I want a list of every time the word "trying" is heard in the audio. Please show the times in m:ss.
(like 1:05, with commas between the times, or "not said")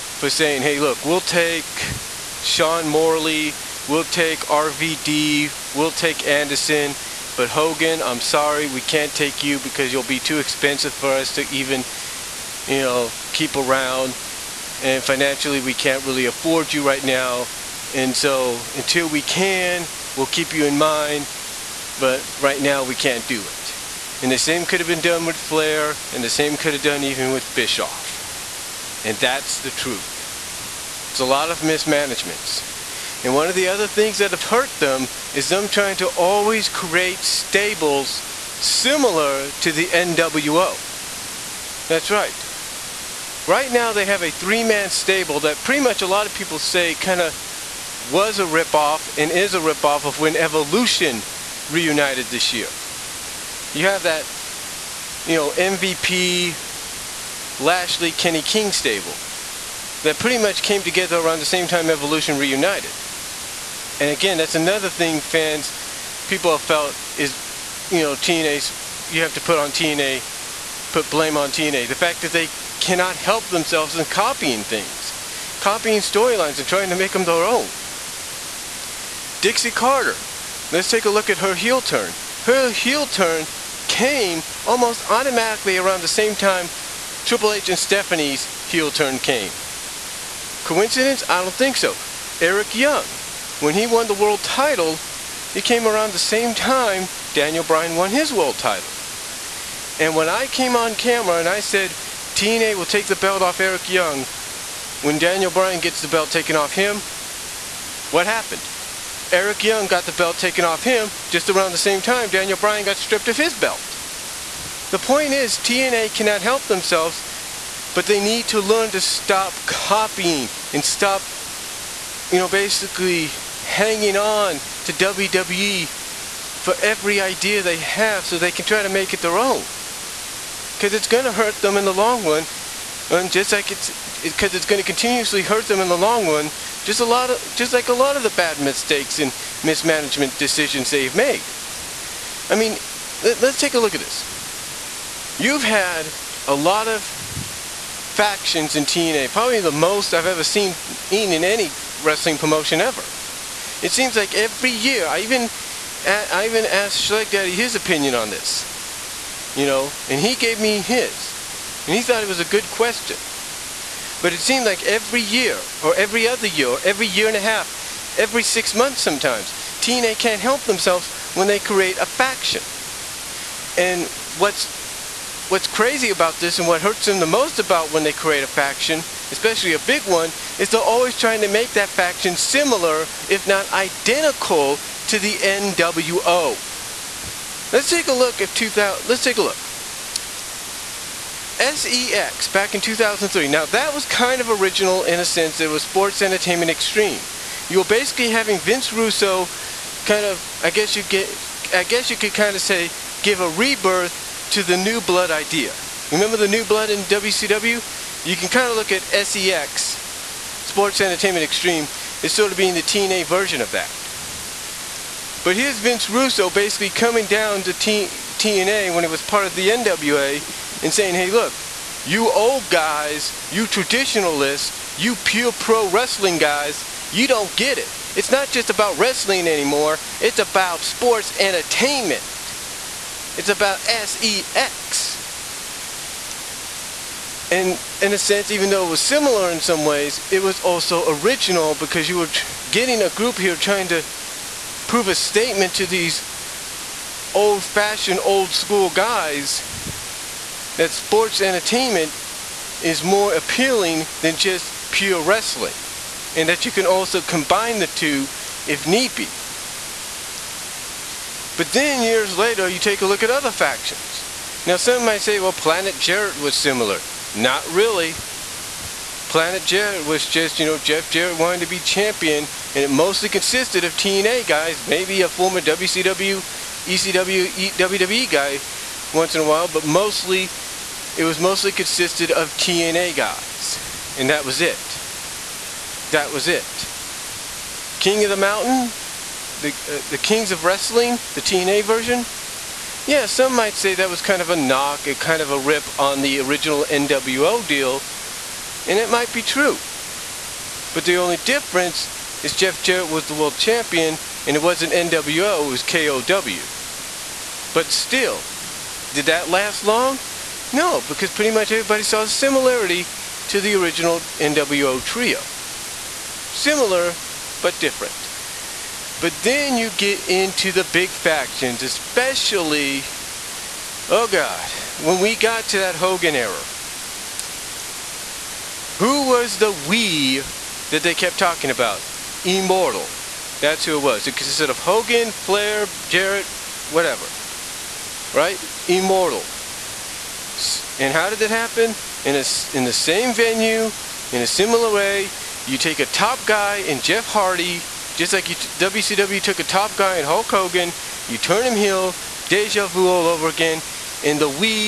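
0:35, 1:16, 3:01, 4:03.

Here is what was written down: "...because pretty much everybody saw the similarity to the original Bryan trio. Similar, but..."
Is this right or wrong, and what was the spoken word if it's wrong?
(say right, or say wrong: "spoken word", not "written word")
wrong: "NWO", not "Bryan".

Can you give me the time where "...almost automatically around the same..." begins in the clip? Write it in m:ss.
1:24.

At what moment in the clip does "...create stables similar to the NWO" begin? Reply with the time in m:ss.
0:36.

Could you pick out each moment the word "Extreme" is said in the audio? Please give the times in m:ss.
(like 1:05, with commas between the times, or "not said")
3:16, 3:31.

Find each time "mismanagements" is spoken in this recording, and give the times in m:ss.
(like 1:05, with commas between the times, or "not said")
0:31, 2:19.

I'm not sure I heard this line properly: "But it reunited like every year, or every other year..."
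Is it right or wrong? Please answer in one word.
wrong.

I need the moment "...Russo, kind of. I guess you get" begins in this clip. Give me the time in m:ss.
3:18.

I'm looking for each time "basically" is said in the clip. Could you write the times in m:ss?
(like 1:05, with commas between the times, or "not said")
2:02, 3:17, 3:36.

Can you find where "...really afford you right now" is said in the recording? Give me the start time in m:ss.
0:16.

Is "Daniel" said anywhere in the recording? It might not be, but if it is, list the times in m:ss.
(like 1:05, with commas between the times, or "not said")
1:37, 1:45, 1:52.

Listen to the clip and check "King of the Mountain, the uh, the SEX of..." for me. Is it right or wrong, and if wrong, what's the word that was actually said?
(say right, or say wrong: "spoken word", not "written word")
wrong: "Kings", not "SEX".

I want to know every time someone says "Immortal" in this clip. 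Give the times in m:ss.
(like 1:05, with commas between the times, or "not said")
5:32, 5:38.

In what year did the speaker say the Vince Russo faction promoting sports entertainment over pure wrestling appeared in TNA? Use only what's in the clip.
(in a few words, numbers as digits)
2003.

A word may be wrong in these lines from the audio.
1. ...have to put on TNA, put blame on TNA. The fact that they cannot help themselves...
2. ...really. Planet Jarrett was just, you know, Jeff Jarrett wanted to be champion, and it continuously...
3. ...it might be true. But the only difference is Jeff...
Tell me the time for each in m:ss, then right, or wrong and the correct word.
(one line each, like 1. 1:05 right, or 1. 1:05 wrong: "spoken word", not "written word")
1. 1:09 right
2. 4:27 wrong: "mostly", not "continuously"
3. 4:58 right.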